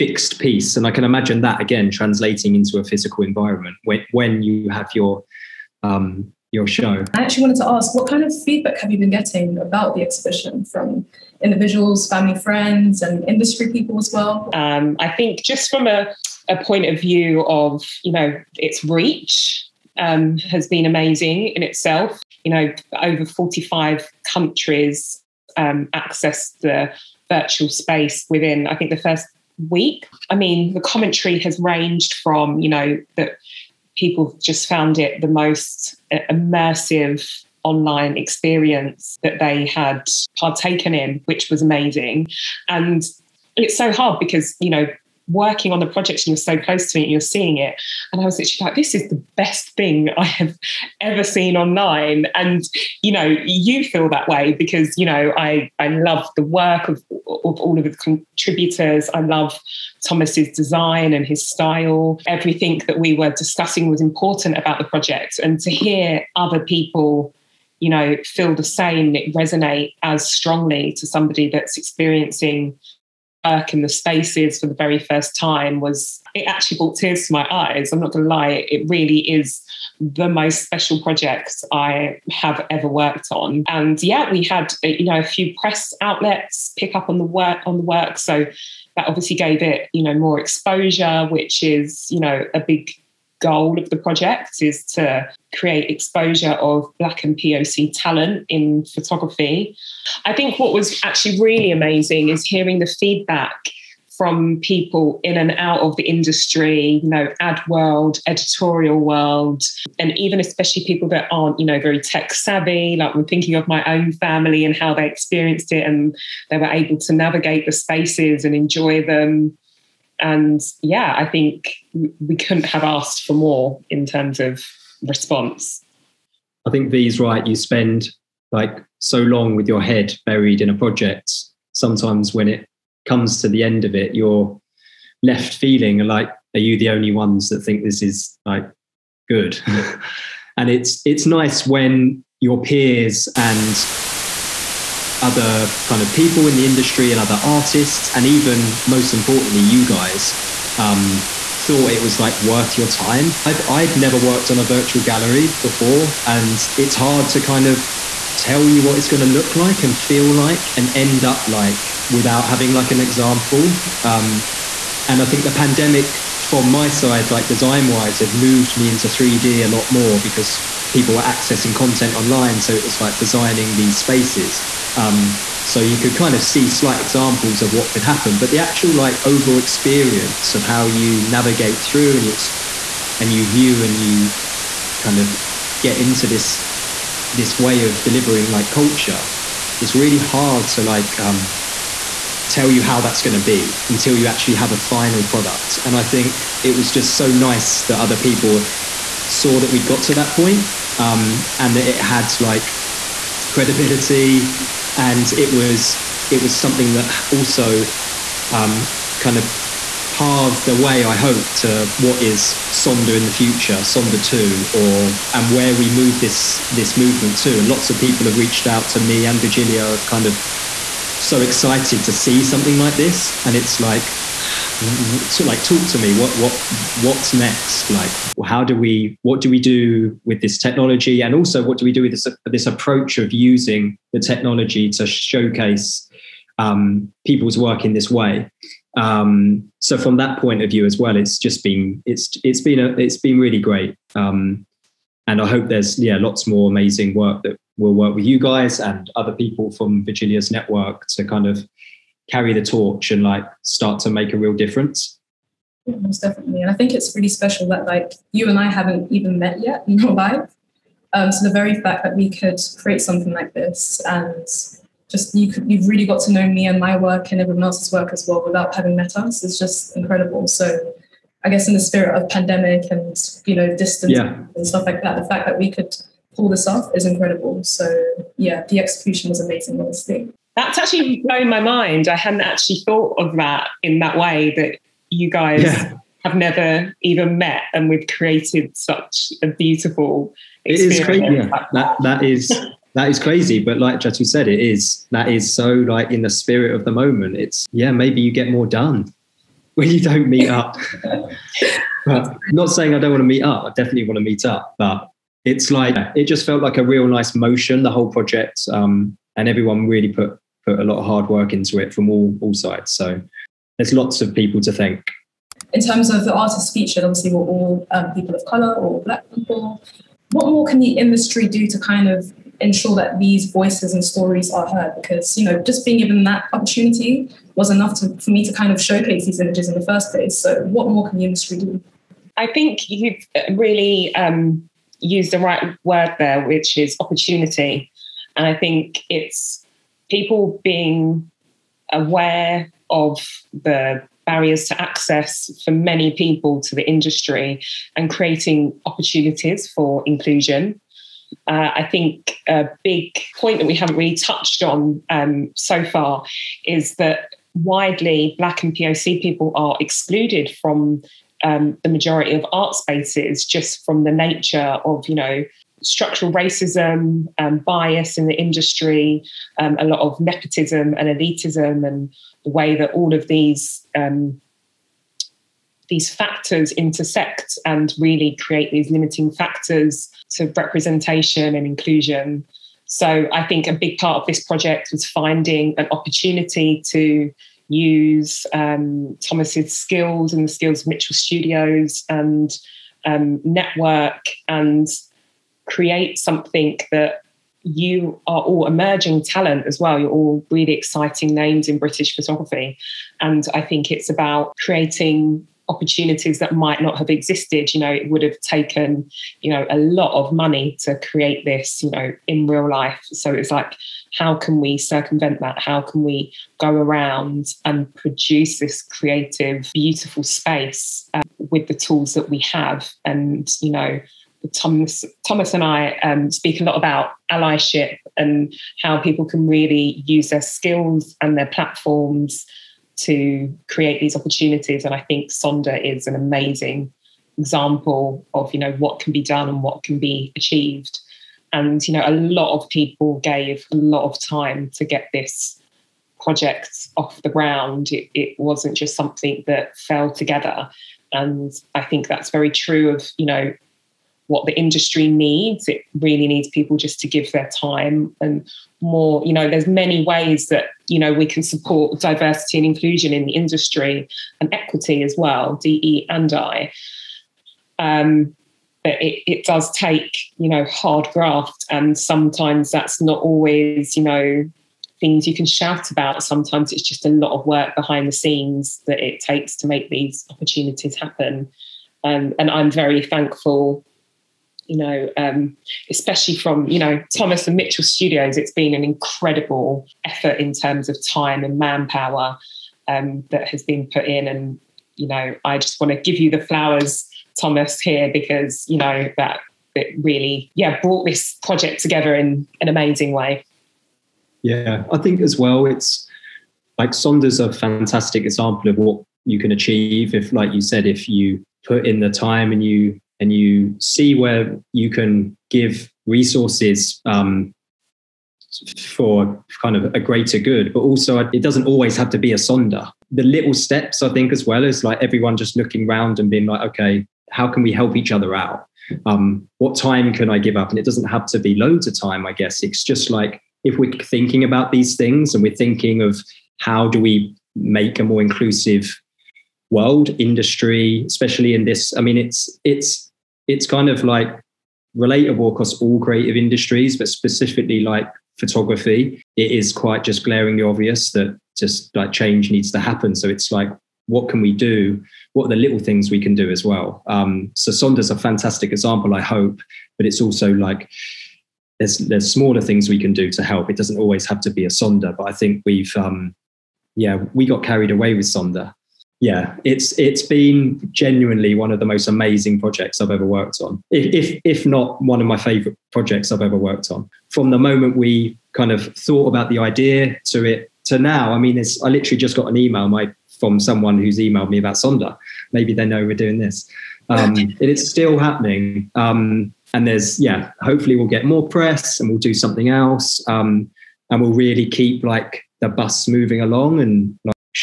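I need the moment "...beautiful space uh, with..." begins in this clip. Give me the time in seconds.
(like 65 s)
419 s.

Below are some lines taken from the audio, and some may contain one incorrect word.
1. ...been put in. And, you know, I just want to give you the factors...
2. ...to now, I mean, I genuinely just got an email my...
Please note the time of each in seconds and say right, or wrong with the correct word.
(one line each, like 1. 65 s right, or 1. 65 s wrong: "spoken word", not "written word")
1. 493 s wrong: "flowers", not "factors"
2. 580 s wrong: "literally", not "genuinely".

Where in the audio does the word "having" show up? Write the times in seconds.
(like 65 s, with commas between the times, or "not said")
162 s, 268 s.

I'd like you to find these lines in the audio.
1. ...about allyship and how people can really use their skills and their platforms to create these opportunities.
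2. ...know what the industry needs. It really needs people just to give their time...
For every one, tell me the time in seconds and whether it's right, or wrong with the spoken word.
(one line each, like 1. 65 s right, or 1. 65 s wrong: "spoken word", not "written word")
1. 426 s right
2. 453 s right.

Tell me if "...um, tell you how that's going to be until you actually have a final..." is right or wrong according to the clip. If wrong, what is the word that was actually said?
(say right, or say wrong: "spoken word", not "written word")
right.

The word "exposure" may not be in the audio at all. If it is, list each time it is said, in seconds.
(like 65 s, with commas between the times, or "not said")
90 s, 95 s.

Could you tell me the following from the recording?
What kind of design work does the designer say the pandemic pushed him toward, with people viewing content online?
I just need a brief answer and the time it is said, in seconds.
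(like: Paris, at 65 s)
3D, at 169 s.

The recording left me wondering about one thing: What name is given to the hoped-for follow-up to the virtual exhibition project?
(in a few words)
Sonder two.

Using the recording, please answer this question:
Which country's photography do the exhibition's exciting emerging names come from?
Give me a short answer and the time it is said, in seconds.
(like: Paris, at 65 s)
British, at 401 s.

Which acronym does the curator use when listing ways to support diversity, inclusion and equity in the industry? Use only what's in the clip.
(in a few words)
DE and I.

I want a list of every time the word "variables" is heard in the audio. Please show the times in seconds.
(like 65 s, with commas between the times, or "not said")
not said.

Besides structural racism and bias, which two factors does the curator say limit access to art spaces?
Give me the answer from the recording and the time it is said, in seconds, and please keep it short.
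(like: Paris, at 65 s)
nepotism and elitism, at 370 s.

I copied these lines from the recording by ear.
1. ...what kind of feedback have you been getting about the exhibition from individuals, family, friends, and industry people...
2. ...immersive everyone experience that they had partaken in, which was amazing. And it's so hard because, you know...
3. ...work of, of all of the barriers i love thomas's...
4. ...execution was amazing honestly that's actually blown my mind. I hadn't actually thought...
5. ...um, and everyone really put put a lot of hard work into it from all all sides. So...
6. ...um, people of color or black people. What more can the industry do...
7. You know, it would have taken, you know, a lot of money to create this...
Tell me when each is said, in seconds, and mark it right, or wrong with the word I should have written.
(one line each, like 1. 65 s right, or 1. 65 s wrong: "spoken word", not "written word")
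1. 7 s right
2. 36 s wrong: "online", not "everyone"
3. 56 s wrong: "contributors", not "barriers"
4. 278 s right
5. 308 s right
6. 317 s right
7. 407 s right.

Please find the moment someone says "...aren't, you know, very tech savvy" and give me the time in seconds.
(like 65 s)
111 s.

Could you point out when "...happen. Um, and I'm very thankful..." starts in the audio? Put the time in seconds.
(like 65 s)
480 s.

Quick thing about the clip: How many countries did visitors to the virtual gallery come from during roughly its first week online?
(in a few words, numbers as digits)
over 45.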